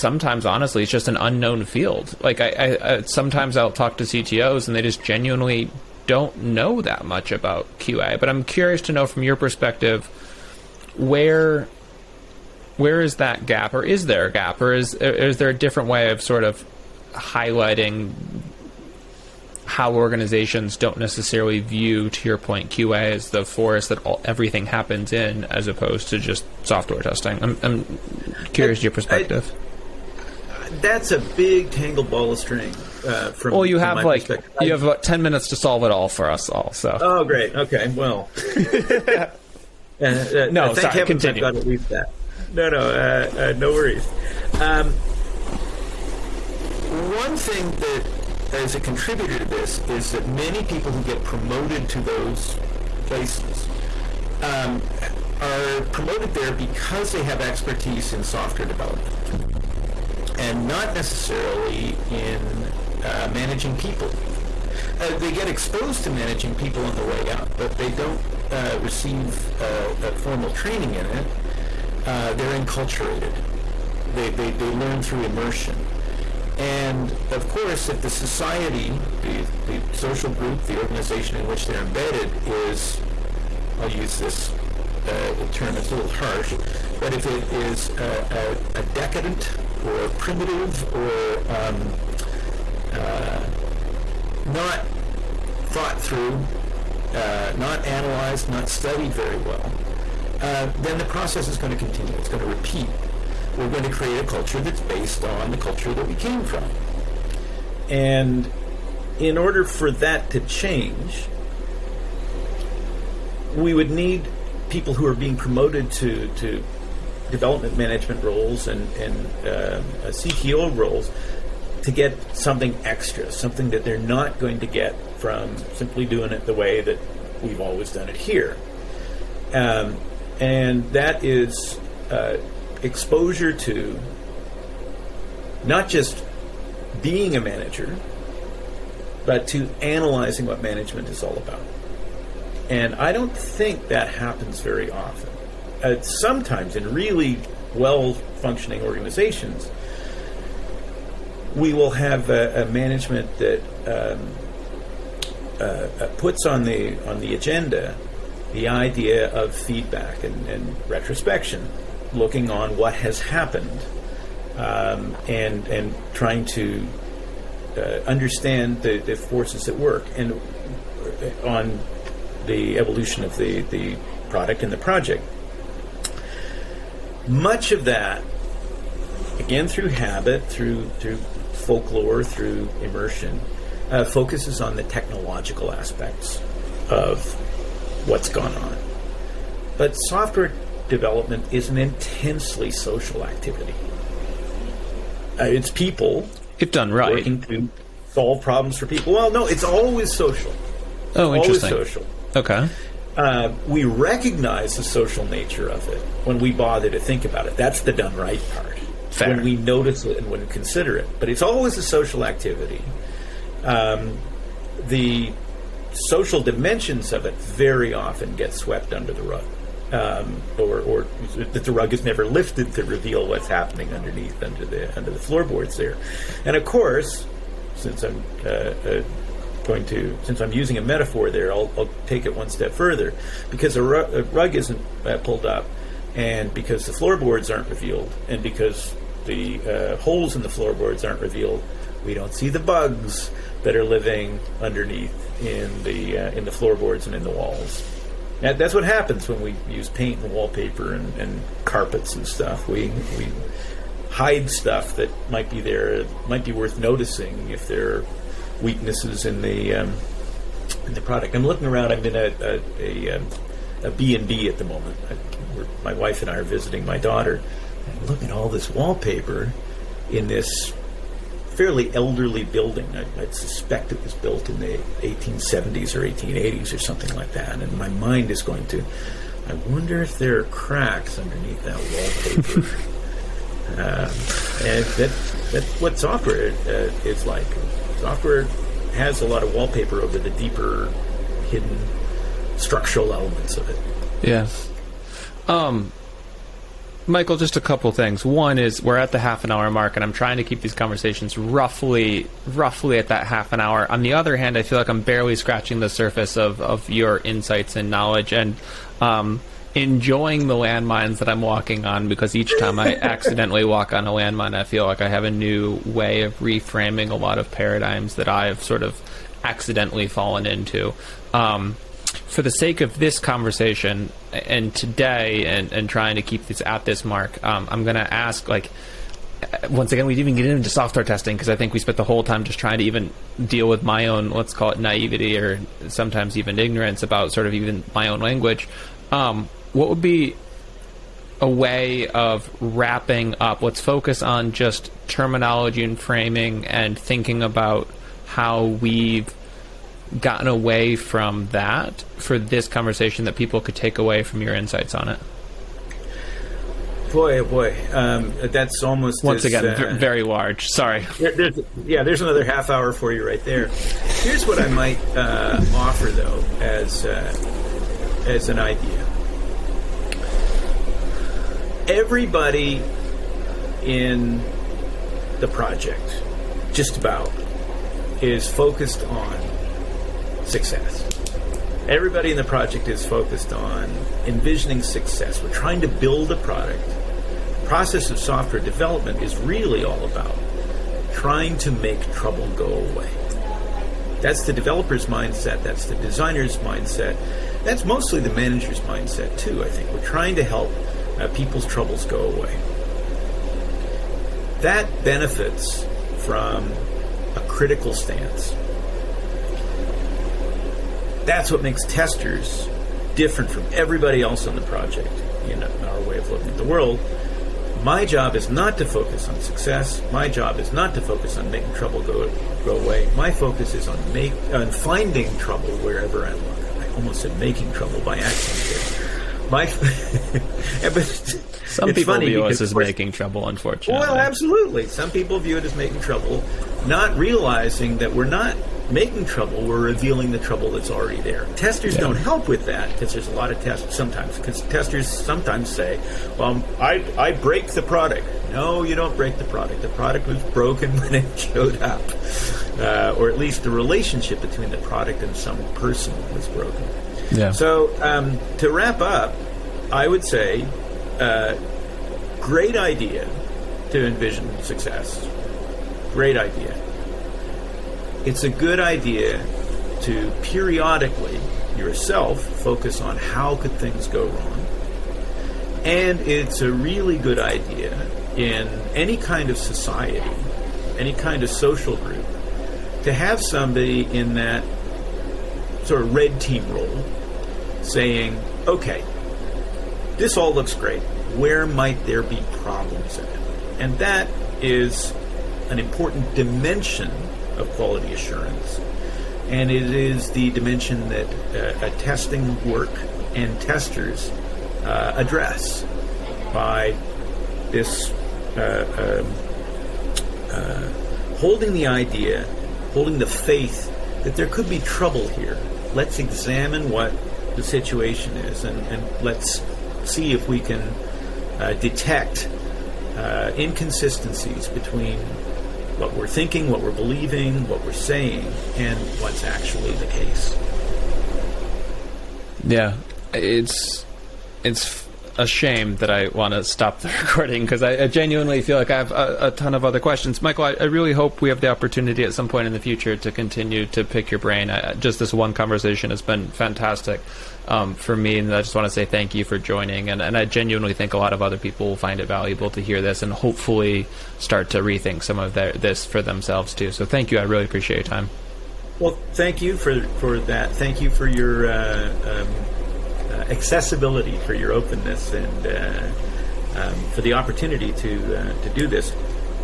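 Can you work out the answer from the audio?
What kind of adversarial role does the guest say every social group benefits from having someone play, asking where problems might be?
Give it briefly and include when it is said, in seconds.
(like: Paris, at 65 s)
red team, at 486 s.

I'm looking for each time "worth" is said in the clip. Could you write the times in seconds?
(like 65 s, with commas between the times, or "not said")
256 s.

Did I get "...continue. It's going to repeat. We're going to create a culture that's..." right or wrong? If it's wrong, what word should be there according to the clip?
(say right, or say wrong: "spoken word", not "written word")
right.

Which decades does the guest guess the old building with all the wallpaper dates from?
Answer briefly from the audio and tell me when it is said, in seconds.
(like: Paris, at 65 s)
1870s or 1880s, at 275 s.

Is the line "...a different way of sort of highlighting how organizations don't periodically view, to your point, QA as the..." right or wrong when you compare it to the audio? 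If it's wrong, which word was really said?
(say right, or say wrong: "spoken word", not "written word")
wrong: "necessarily", not "periodically".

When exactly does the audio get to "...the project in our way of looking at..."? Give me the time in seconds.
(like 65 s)
414 s.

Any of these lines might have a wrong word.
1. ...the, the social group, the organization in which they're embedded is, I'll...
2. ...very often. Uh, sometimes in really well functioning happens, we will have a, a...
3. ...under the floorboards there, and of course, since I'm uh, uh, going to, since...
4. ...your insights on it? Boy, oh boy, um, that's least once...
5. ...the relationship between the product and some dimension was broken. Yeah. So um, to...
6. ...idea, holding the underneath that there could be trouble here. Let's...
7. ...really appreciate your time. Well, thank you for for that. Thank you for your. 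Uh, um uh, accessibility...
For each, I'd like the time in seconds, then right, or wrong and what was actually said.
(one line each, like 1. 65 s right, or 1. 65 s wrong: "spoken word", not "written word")
1. 79 s right
2. 144 s wrong: "organizations", not "happens"
3. 224 s right
4. 354 s wrong: "almost", not "least"
5. 453 s wrong: "person", not "dimension"
6. 511 s wrong: "faith", not "underneath"
7. 557 s right.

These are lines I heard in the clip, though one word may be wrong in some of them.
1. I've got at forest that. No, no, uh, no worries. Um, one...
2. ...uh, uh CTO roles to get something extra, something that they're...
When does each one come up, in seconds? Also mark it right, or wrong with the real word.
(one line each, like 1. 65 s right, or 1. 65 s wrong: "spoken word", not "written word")
1. 41 s wrong: "least", not "forest"
2. 119 s right.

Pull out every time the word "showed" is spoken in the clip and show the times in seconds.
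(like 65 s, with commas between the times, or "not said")
451 s.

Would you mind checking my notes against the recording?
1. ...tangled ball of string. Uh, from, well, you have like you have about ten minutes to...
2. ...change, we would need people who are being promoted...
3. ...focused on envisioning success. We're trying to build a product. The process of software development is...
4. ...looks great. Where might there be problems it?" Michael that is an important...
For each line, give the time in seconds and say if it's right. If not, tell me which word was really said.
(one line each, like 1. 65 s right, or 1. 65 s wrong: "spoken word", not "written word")
1. 31 s right
2. 110 s right
3. 383 s right
4. 490 s wrong: "And", not "Michael".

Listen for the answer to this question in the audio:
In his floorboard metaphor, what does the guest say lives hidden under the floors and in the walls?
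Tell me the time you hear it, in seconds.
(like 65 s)
242 s.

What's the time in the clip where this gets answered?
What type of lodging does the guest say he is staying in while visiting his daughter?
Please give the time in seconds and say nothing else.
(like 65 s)
263 s.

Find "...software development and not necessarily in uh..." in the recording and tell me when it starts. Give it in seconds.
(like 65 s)
58 s.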